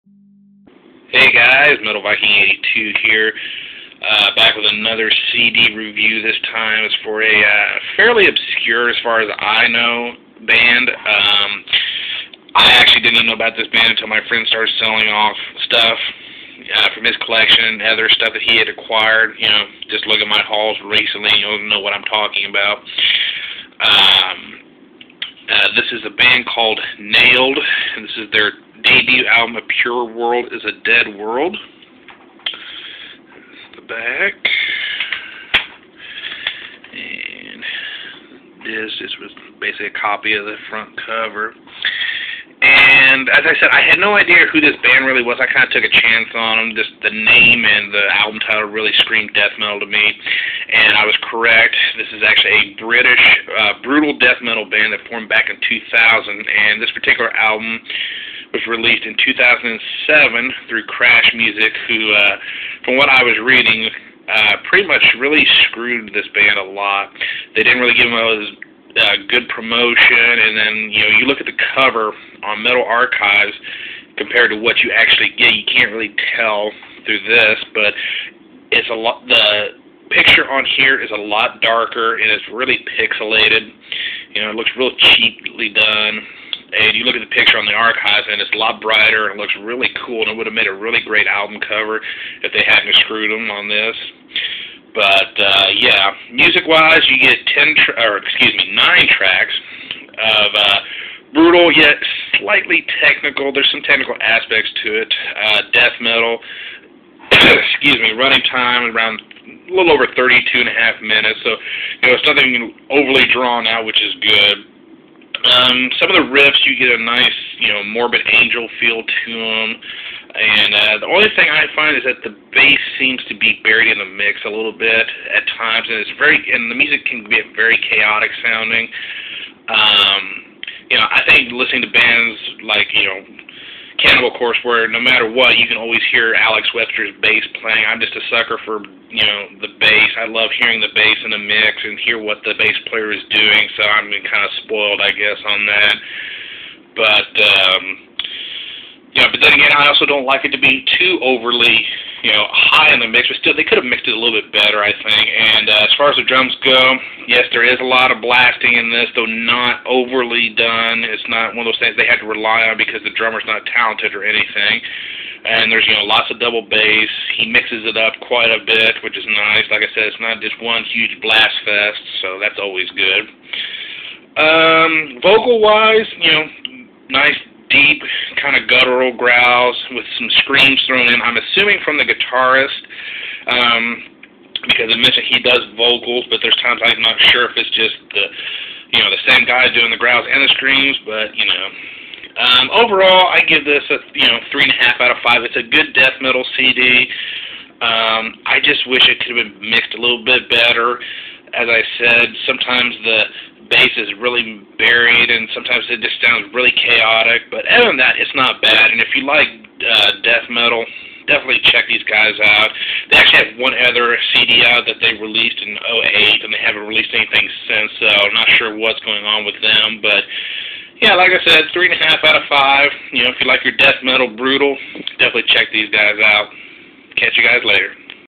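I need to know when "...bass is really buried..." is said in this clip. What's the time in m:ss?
3:23.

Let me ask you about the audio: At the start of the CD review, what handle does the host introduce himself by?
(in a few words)
Metal Viking 82.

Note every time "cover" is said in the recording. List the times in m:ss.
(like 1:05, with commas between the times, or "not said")
0:41, 1:11, 1:31.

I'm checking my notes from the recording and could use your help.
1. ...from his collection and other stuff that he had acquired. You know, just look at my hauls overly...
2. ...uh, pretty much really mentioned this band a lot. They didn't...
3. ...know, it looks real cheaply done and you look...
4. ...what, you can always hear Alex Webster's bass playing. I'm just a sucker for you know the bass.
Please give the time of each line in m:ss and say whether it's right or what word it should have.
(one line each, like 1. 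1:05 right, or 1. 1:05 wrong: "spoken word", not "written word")
1. 0:16 wrong: "recently", not "overly"
2. 1:04 wrong: "screwed", not "mentioned"
3. 1:24 right
4. 2:15 right.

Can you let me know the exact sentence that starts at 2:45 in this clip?
And there's you know lots of double bass.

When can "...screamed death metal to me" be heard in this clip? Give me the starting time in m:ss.
0:49.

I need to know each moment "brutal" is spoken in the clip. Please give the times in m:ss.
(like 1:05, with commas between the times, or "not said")
0:53, 1:41, 3:44.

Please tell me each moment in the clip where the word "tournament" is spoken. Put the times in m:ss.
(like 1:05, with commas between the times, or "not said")
not said.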